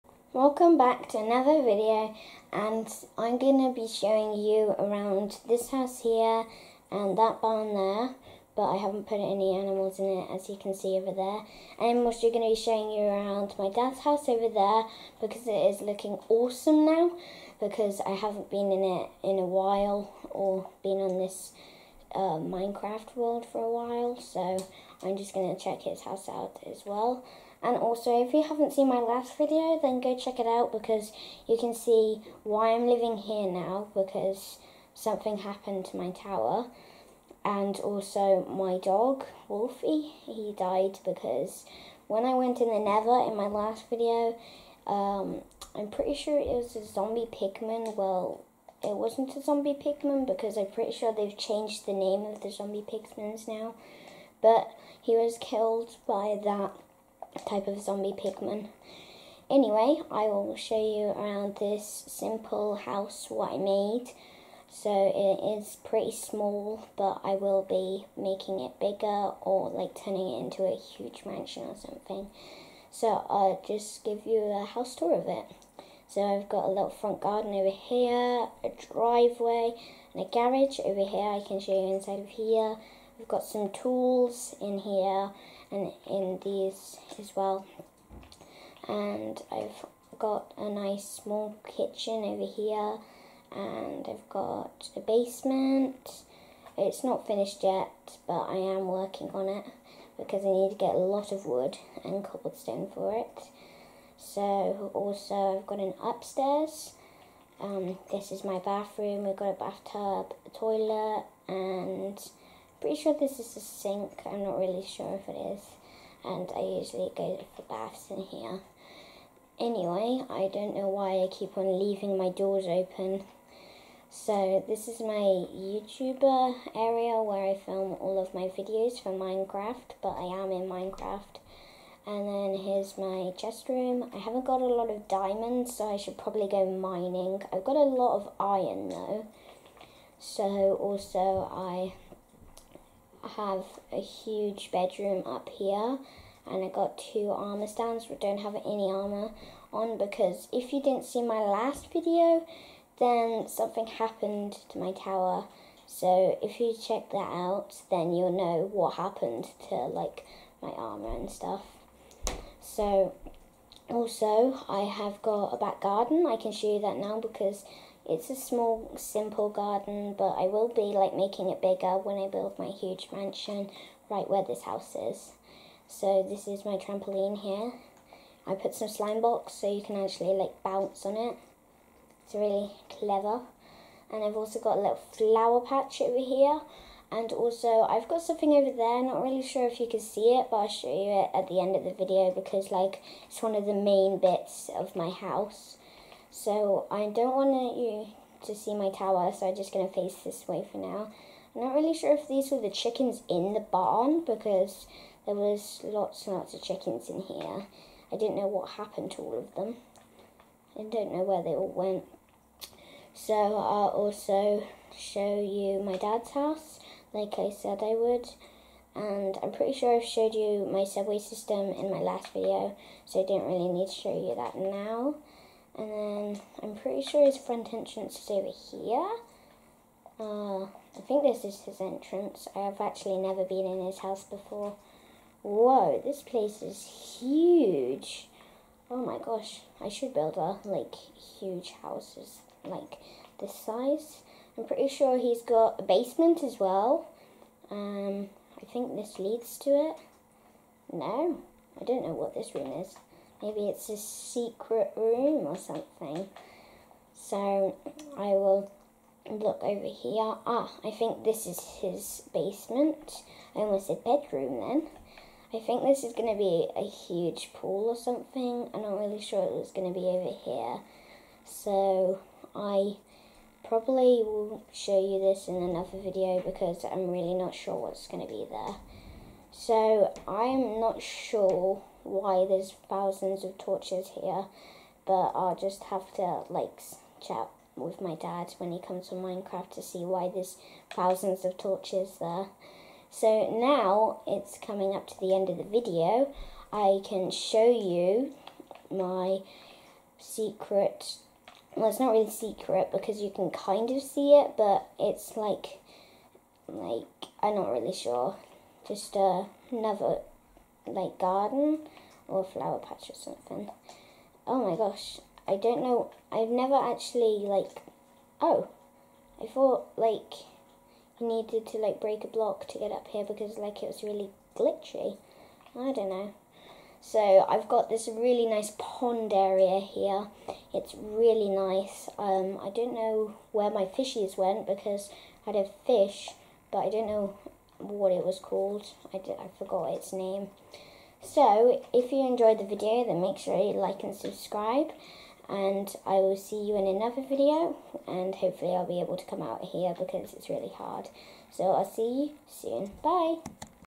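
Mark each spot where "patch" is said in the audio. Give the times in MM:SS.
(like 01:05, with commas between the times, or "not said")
03:05, 05:12.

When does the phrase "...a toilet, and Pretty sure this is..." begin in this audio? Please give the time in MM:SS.
01:50.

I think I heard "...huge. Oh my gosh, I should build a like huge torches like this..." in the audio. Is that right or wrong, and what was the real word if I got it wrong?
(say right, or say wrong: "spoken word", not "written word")
wrong: "houses", not "torches".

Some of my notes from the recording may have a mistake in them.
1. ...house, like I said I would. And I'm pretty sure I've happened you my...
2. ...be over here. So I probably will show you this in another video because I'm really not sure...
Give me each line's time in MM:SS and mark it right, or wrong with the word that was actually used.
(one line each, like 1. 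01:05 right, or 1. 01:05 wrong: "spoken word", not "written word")
1. 03:36 wrong: "showed", not "happened"
2. 04:29 right.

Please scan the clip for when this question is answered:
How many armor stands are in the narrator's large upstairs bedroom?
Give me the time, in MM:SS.
02:26.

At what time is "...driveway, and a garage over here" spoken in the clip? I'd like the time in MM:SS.
01:18.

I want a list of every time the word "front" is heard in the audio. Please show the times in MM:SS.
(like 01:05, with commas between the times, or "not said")
01:16, 03:47.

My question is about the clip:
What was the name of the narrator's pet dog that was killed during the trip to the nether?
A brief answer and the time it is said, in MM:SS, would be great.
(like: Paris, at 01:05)
Wolfie, at 00:39.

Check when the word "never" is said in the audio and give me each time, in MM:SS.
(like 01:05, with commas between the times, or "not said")
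03:53, 05:16.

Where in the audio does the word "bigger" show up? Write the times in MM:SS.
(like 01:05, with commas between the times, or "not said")
01:08, 02:51.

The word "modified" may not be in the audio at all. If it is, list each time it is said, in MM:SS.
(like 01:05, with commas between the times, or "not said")
not said.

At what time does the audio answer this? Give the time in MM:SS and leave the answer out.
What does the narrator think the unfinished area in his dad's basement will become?
04:26.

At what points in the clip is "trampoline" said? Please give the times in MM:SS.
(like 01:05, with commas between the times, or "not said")
02:56.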